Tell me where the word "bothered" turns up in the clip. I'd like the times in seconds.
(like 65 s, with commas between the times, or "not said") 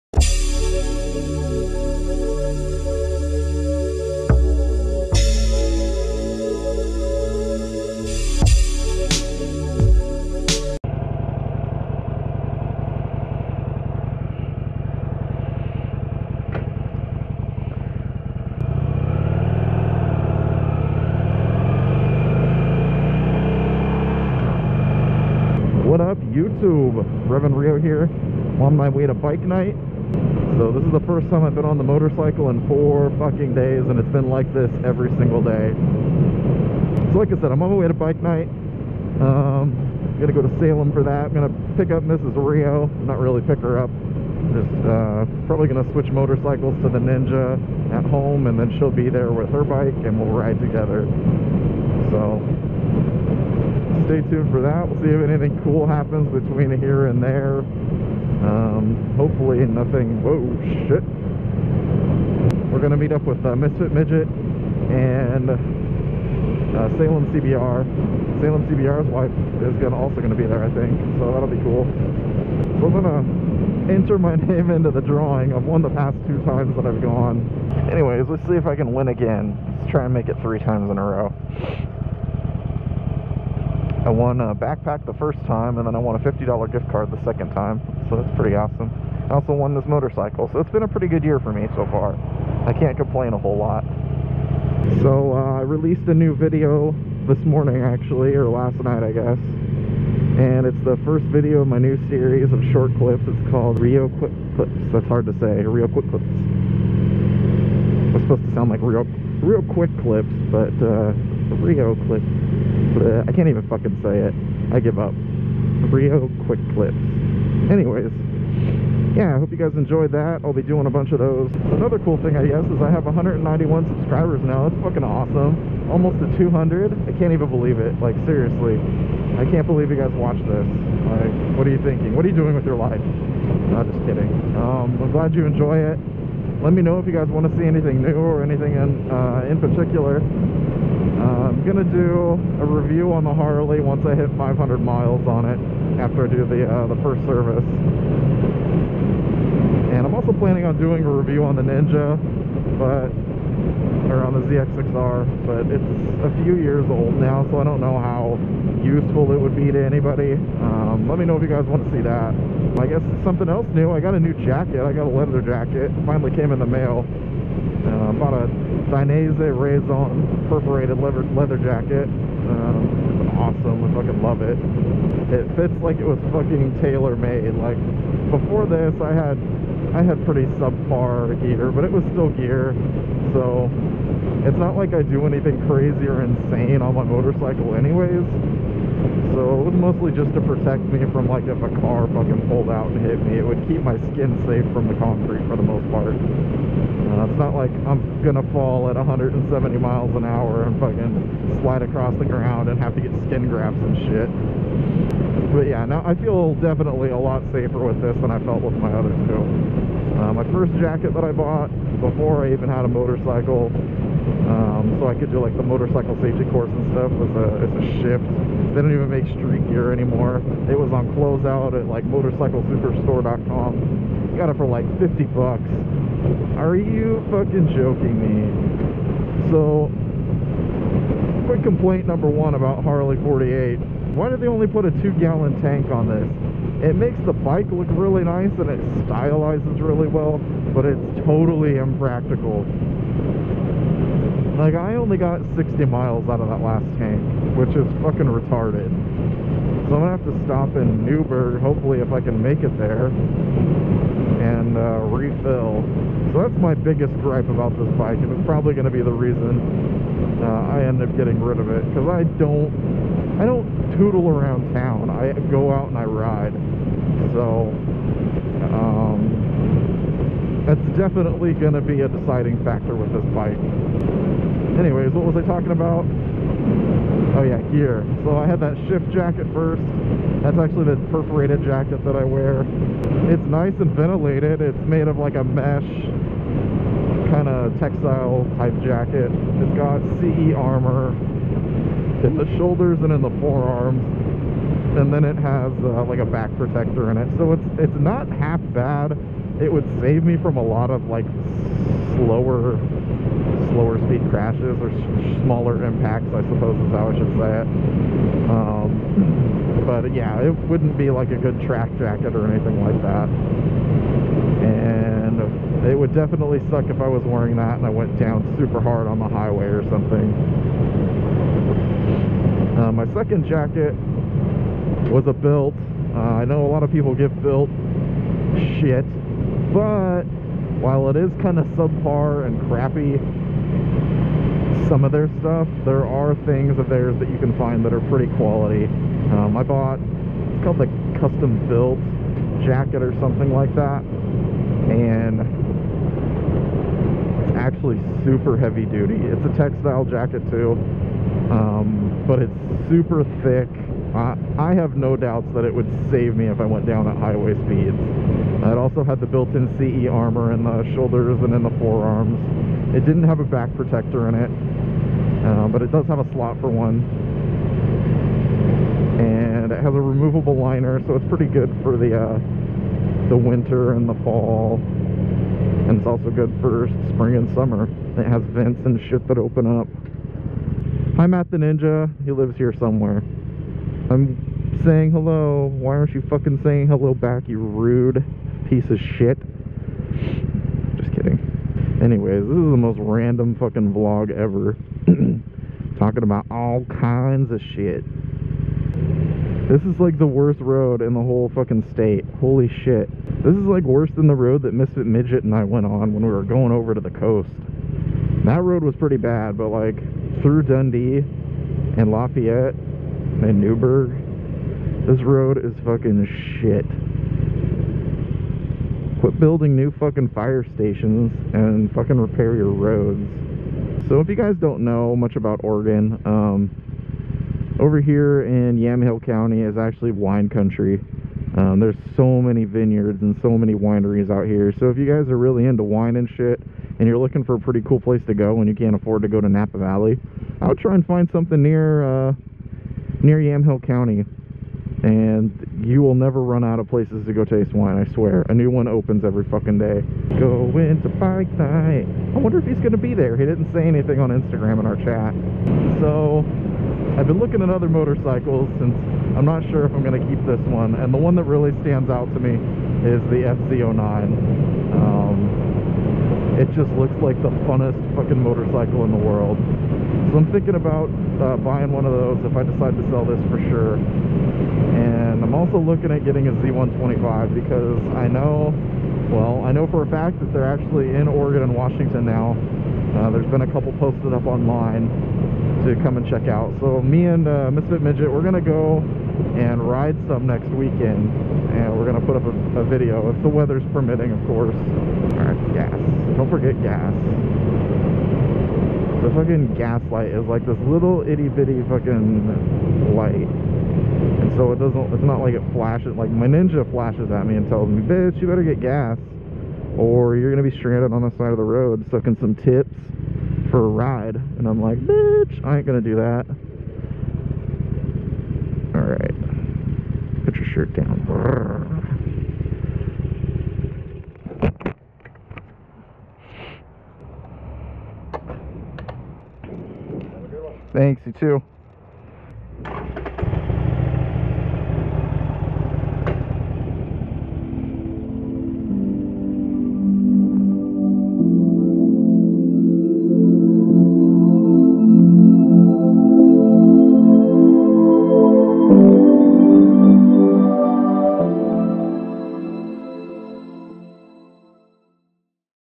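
not said.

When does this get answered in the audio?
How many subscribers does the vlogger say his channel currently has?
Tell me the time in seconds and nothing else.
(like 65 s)
123 s.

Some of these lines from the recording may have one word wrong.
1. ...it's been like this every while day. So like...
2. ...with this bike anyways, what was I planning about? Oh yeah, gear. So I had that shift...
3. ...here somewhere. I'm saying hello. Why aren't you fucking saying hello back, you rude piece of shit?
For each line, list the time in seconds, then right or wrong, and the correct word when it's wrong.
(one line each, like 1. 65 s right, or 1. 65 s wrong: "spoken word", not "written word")
1. 33 s wrong: "single", not "while"
2. 272 s wrong: "talking", not "planning"
3. 382 s right.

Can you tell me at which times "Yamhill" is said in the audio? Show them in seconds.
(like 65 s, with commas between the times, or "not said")
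428 s, 443 s.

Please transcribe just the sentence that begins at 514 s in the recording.
And I'm like, bitch, I ain't gonna do that.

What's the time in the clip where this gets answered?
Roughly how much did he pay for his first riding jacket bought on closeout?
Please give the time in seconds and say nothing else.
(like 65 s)
224 s.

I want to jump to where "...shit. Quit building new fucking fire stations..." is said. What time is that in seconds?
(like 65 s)
416 s.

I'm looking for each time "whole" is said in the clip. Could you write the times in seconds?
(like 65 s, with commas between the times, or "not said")
93 s, 401 s.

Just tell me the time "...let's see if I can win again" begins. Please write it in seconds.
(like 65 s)
78 s.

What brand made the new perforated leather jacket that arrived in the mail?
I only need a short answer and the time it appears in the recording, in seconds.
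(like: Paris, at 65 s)
Dainese, at 168 s.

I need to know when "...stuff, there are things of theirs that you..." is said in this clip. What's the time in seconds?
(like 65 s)
335 s.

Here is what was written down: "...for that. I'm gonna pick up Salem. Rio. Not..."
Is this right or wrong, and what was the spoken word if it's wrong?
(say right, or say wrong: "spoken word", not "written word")
wrong: "Mrs", not "Salem".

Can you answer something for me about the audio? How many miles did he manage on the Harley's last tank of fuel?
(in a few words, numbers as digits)
60.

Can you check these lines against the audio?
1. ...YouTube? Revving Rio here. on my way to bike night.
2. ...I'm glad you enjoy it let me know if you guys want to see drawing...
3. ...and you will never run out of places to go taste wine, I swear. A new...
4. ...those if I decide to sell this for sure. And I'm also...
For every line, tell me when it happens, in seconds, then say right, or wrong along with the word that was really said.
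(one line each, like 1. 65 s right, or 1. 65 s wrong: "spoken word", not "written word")
1. 26 s right
2. 135 s wrong: "anything", not "drawing"
3. 445 s right
4. 472 s right.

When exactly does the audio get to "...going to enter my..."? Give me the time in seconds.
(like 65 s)
72 s.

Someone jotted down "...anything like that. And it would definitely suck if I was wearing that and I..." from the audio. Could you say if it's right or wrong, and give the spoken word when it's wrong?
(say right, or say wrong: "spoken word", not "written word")
right.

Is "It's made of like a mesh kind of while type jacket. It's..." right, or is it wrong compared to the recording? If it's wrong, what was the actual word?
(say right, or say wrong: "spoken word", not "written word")
wrong: "textile", not "while".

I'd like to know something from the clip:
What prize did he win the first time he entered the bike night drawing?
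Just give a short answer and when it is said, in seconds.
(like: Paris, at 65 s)
A backpack, at 84 s.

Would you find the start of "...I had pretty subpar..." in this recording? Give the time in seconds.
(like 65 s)
179 s.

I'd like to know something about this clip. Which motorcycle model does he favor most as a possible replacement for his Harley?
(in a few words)
FZ09.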